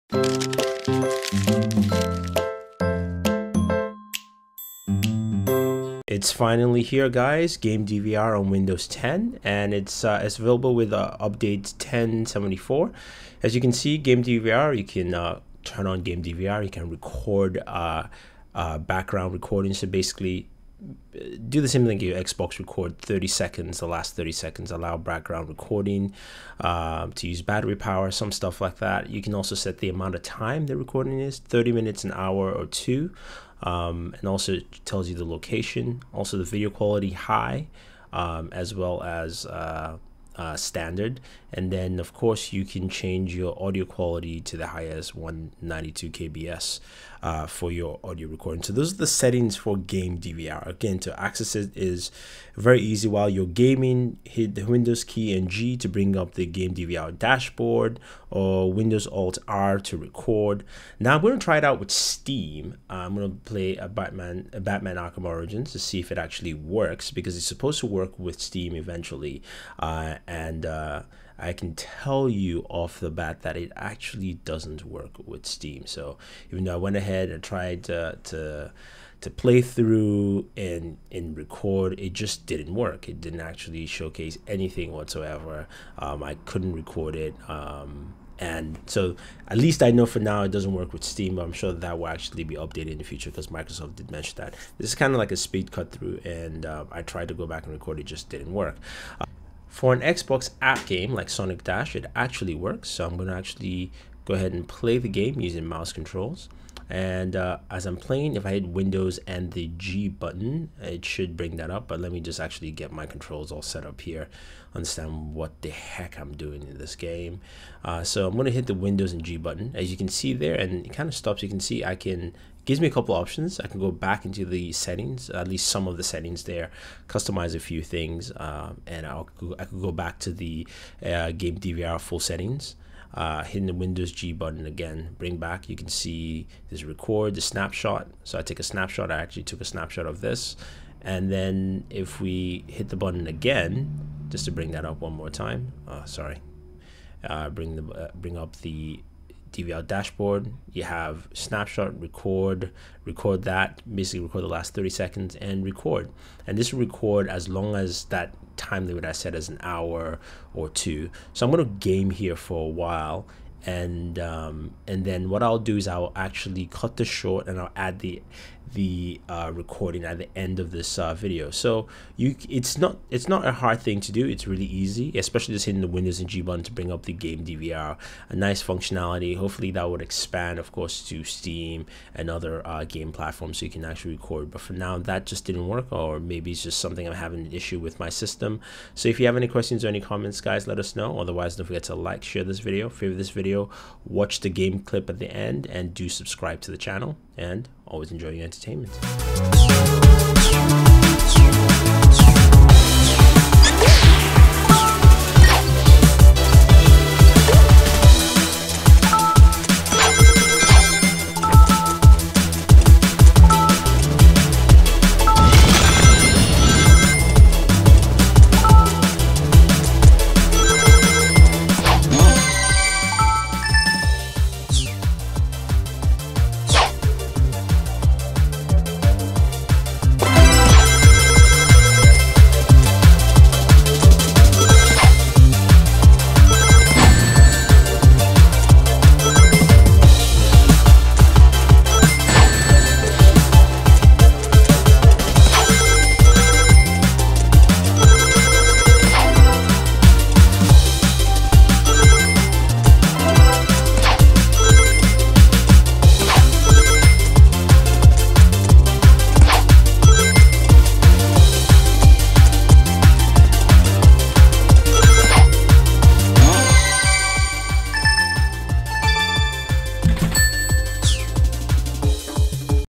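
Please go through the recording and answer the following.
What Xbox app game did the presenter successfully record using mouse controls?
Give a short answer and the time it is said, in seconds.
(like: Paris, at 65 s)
Sonic Dash, at 101 s.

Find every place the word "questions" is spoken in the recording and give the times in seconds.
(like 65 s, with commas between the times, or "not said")
189 s.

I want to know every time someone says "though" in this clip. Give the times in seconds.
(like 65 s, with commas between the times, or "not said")
76 s.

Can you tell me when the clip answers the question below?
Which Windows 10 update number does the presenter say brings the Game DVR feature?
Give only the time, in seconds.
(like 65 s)
11 s.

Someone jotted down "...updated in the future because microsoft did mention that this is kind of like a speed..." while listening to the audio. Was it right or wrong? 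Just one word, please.
right.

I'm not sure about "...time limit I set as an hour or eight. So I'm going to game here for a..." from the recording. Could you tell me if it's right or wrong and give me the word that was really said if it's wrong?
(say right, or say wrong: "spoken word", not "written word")
wrong: "two", not "eight".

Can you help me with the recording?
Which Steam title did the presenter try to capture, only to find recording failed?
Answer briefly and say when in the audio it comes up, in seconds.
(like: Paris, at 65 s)
Batman Arkham Origins, at 64 s.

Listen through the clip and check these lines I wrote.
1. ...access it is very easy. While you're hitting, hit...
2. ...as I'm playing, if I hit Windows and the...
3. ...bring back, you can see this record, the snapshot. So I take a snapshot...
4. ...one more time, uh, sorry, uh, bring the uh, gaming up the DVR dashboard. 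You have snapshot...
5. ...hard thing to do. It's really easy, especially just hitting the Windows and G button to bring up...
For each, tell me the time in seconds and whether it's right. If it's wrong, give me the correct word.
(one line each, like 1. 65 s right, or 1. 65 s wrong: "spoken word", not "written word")
1. 51 s wrong: "gaming", not "hitting"
2. 107 s right
3. 135 s right
4. 145 s wrong: "bring", not "gaming"
5. 173 s right.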